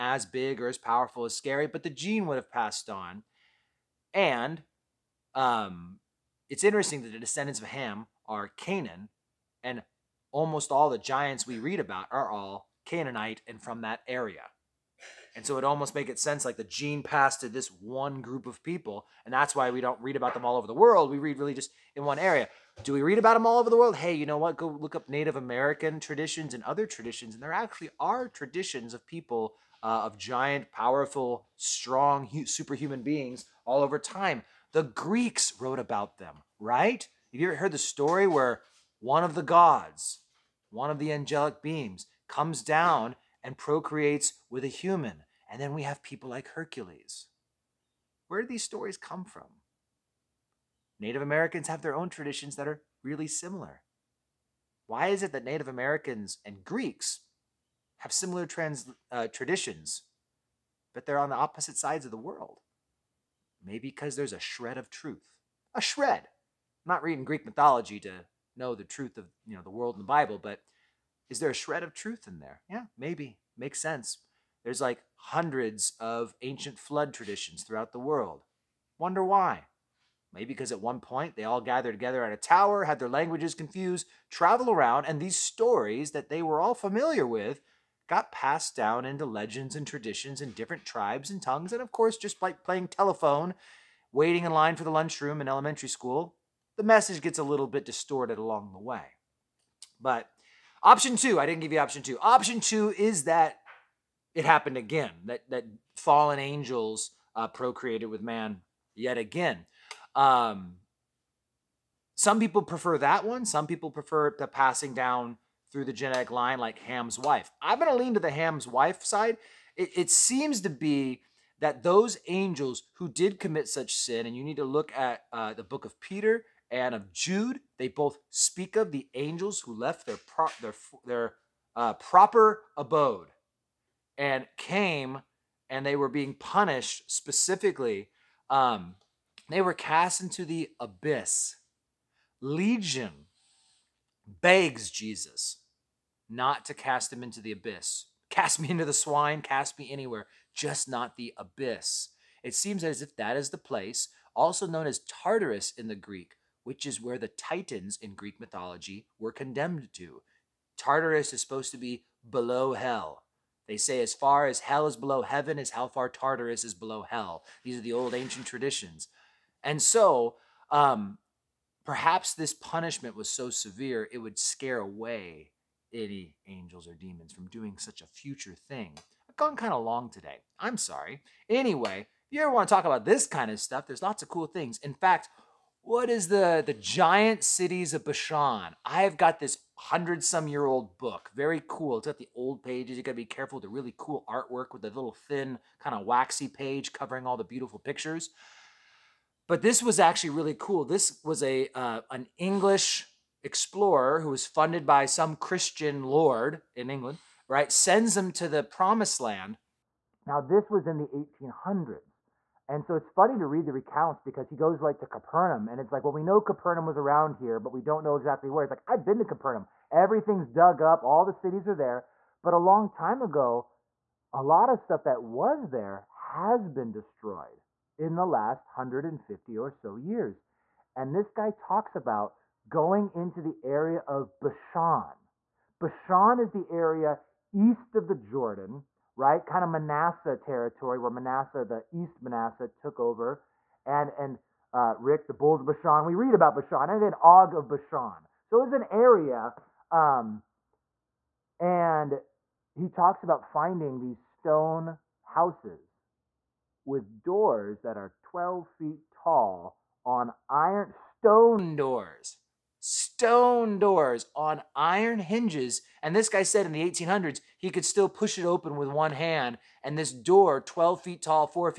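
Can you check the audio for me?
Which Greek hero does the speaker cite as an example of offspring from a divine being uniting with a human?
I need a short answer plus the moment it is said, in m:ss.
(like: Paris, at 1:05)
Hercules, at 0:46.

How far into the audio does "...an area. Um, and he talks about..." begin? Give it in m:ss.
4:08.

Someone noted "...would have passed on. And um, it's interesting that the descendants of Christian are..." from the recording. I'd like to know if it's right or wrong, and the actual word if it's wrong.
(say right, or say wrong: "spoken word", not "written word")
wrong: "Ham", not "Christian".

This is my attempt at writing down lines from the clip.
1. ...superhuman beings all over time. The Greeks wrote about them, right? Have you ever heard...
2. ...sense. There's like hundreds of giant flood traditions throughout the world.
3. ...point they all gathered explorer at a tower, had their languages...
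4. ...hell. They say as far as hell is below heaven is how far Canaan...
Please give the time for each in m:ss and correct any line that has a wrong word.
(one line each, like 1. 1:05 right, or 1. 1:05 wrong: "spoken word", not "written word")
1. 0:32 right
2. 1:13 wrong: "ancient", not "giant"
3. 1:20 wrong: "together", not "explorer"
4. 2:42 wrong: "Tartarus", not "Canaan".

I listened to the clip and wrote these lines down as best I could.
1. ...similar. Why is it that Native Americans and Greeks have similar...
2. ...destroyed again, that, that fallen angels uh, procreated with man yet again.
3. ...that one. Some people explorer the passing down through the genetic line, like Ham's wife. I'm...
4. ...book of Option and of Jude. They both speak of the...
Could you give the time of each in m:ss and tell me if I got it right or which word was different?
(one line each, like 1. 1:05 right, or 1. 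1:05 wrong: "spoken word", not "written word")
1. 0:53 right
2. 1:44 wrong: "happened", not "destroyed"
3. 1:52 wrong: "prefer", not "explorer"
4. 2:05 wrong: "Peter", not "Option".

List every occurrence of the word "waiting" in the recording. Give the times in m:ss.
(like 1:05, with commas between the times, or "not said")
1:34.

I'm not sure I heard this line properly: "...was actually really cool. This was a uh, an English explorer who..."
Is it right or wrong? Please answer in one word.
right.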